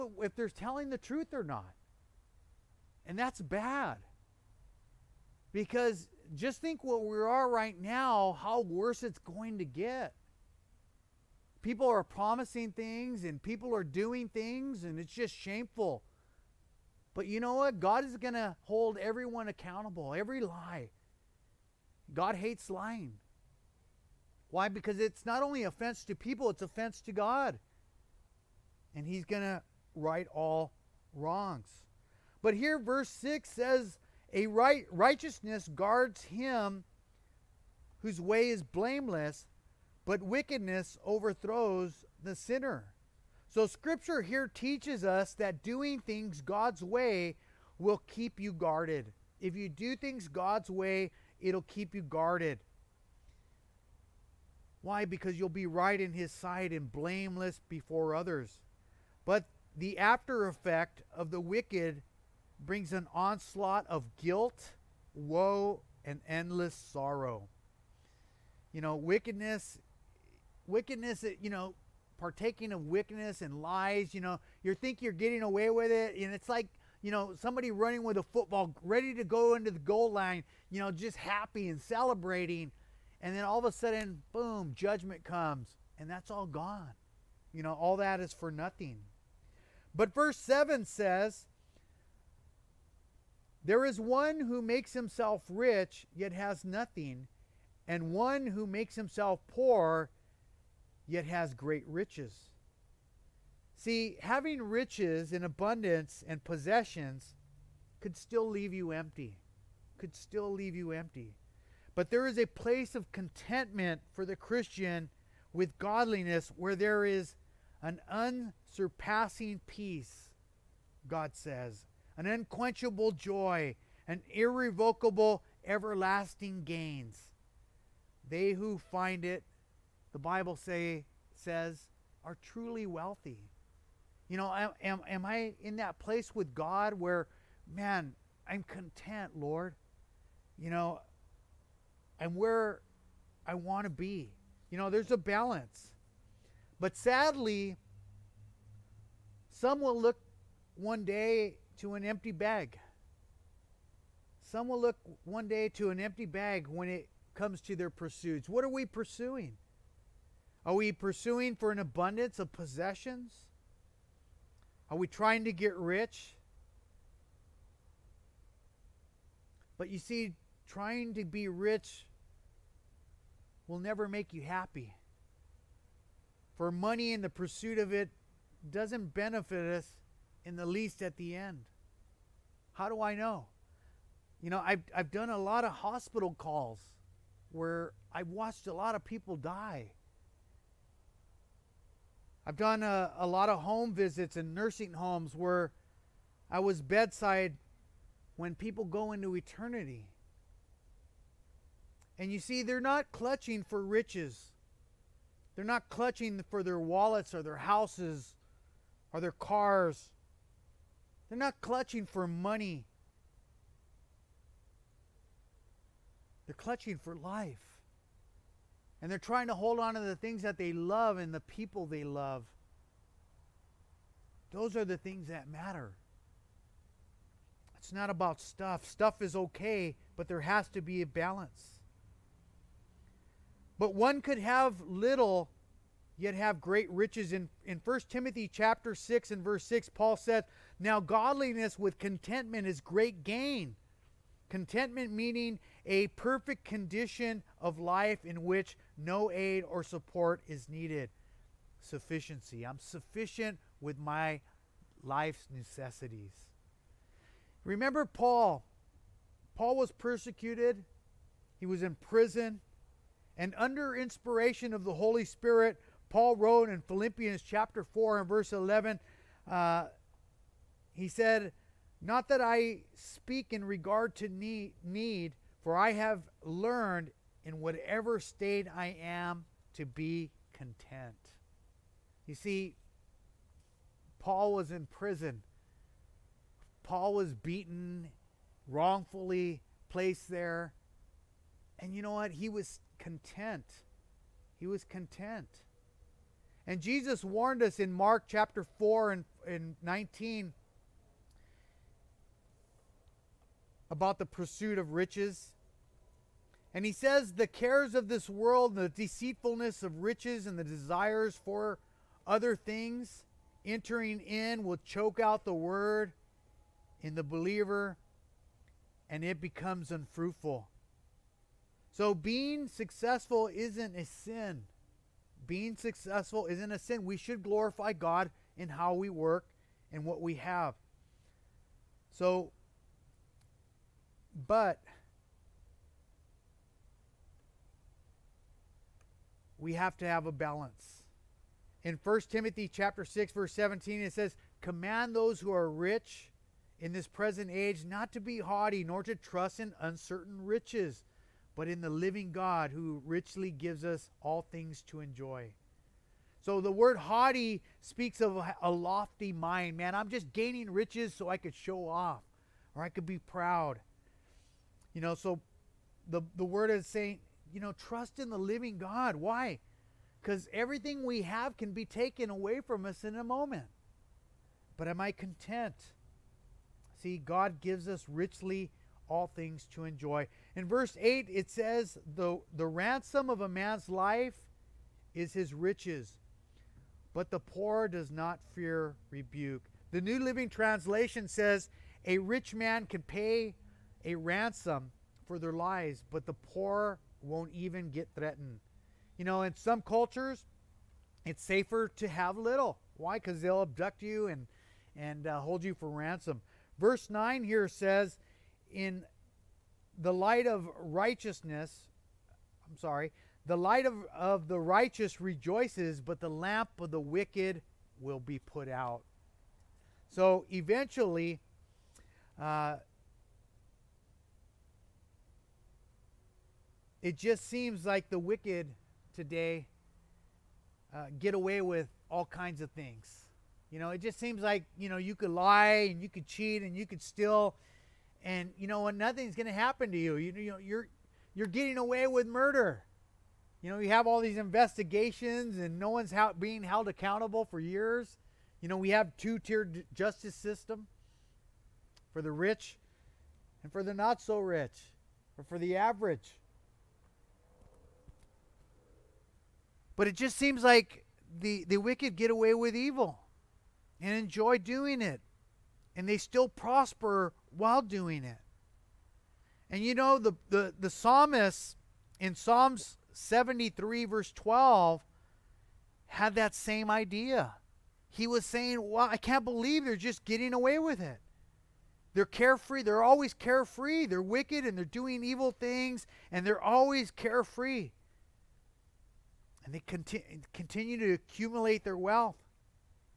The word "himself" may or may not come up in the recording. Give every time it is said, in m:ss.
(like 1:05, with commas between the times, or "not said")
1:34, 1:38.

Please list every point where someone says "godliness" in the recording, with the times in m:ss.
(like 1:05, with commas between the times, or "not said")
1:55, 4:00.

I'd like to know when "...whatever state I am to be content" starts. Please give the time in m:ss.
4:37.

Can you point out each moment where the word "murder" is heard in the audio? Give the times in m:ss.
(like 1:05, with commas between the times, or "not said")
7:22.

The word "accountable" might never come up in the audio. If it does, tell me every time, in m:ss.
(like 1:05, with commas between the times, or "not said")
0:19, 7:26.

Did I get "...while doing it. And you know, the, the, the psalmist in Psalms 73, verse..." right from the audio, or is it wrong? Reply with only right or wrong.
right.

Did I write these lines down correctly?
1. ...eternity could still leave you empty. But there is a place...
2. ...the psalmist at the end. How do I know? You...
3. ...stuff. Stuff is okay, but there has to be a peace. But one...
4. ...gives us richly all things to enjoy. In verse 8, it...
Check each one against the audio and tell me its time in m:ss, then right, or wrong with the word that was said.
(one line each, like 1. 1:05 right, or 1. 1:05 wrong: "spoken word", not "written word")
1. 1:48 wrong: "empty", not "eternity"
2. 3:00 wrong: "least", not "psalmist"
3. 3:48 wrong: "balance", not "peace"
4. 6:17 right.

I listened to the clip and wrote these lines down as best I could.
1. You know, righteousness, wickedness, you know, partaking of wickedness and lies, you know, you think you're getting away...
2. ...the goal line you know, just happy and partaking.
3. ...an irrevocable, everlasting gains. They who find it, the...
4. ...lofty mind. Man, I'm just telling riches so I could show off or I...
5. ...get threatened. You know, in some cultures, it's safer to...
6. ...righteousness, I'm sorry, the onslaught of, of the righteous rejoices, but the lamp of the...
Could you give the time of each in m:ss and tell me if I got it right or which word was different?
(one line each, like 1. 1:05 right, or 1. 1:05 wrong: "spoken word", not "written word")
1. 1:08 wrong: "wickedness", not "righteousness"
2. 1:19 wrong: "celebrating", not "partaking"
3. 2:04 right
4. 5:58 wrong: "gaining", not "telling"
5. 6:37 right
6. 6:50 wrong: "light", not "onslaught".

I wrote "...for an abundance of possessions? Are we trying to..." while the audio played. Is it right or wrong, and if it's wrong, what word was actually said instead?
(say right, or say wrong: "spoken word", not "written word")
right.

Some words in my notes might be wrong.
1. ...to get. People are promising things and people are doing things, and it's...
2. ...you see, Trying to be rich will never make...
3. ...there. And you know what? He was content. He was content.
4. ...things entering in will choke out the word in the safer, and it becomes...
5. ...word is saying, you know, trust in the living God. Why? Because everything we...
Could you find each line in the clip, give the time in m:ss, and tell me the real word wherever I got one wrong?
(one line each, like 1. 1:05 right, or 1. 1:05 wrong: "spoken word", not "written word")
1. 0:09 right
2. 2:49 right
3. 4:50 right
4. 5:12 wrong: "believer", not "safer"
5. 6:06 right.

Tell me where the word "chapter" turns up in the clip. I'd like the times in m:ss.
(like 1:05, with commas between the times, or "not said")
3:58, 4:27, 4:58, 5:42.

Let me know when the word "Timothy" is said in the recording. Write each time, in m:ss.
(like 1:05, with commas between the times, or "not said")
3:58, 5:42.